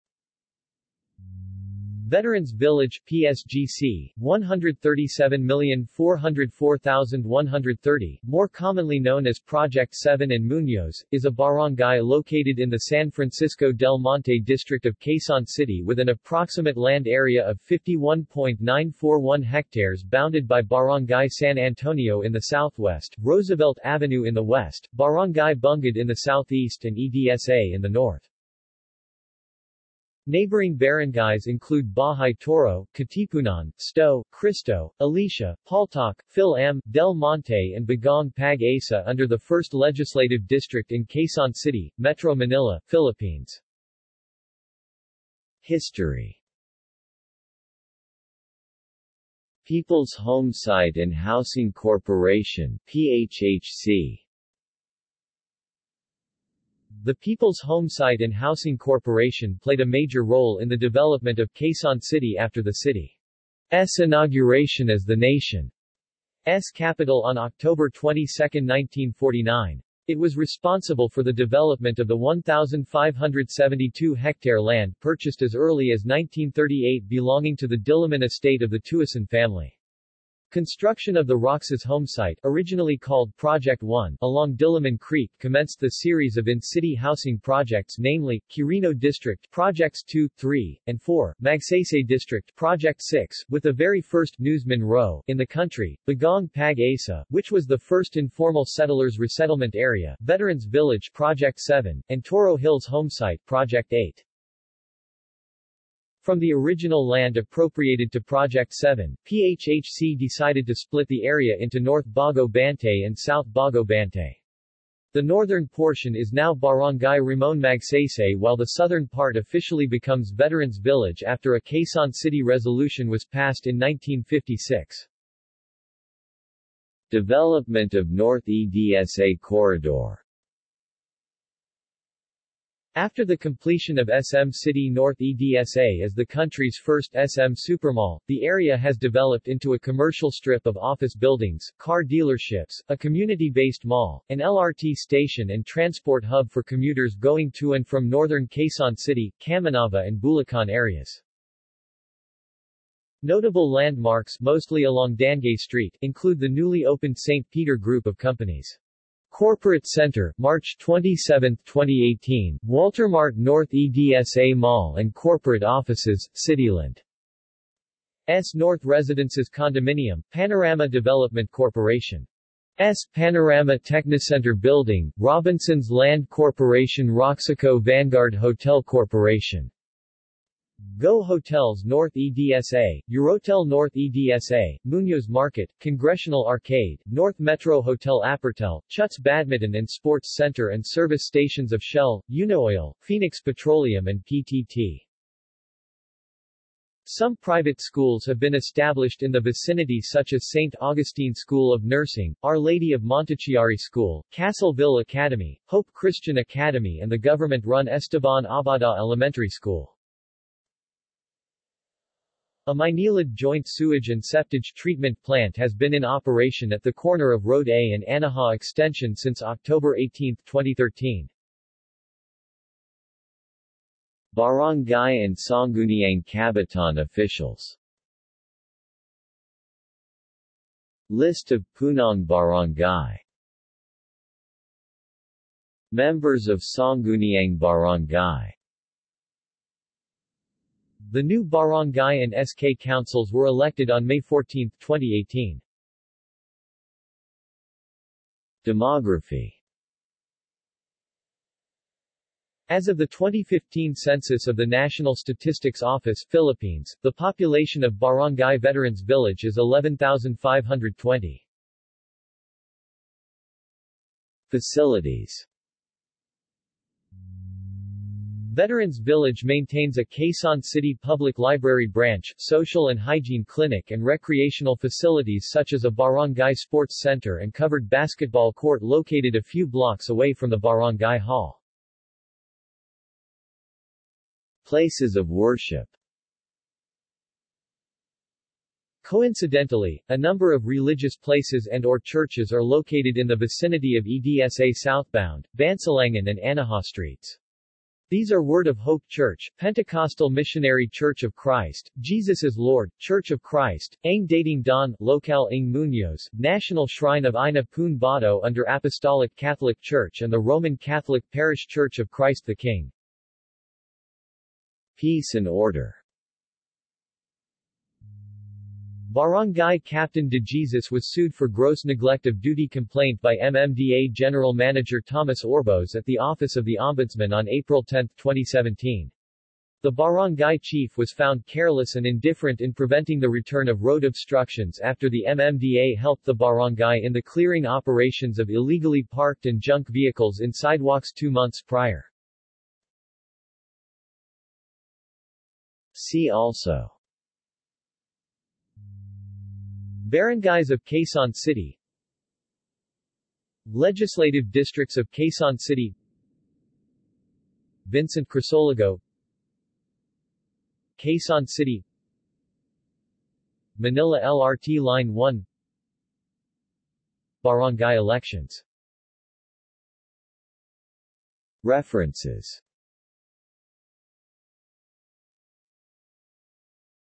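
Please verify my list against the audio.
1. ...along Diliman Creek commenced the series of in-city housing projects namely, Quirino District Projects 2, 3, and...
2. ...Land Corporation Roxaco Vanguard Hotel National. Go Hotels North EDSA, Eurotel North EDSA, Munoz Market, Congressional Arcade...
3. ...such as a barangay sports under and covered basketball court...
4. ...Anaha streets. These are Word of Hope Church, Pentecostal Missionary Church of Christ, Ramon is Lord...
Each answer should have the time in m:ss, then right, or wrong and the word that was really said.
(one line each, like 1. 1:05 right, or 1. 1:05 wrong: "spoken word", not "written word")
1. 1:24 right
2. 2:55 wrong: "Corporation", not "National"
3. 4:35 wrong: "center", not "under"
4. 4:56 wrong: "Jesus", not "Ramon".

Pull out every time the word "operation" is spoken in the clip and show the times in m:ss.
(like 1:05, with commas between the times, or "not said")
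3:36, 5:37.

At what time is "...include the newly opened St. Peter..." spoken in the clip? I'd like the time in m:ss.
2:36.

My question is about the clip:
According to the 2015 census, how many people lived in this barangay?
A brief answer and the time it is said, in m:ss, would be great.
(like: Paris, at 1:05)
11,520, at 4:19.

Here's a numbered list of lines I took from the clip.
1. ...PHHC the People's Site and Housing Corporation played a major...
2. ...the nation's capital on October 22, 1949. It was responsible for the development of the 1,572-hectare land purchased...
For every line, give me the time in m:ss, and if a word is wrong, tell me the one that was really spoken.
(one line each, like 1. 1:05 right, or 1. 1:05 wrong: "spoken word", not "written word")
1. 0:52 right
2. 1:05 right.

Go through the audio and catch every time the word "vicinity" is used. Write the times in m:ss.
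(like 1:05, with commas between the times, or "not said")
3:19, 4:53.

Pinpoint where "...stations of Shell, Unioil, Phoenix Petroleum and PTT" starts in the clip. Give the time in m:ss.
3:11.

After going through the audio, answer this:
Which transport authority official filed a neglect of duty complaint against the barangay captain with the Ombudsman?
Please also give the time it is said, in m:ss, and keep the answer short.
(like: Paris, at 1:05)
Thomas Orbos, at 5:25.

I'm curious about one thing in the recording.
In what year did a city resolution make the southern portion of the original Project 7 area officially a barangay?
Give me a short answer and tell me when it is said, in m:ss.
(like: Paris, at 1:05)
1956, at 2:03.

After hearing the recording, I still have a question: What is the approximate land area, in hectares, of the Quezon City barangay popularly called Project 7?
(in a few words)
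51.941 hectares.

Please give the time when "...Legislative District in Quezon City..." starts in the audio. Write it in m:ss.
0:39.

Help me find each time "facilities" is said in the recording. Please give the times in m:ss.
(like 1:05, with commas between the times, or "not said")
4:24, 4:34.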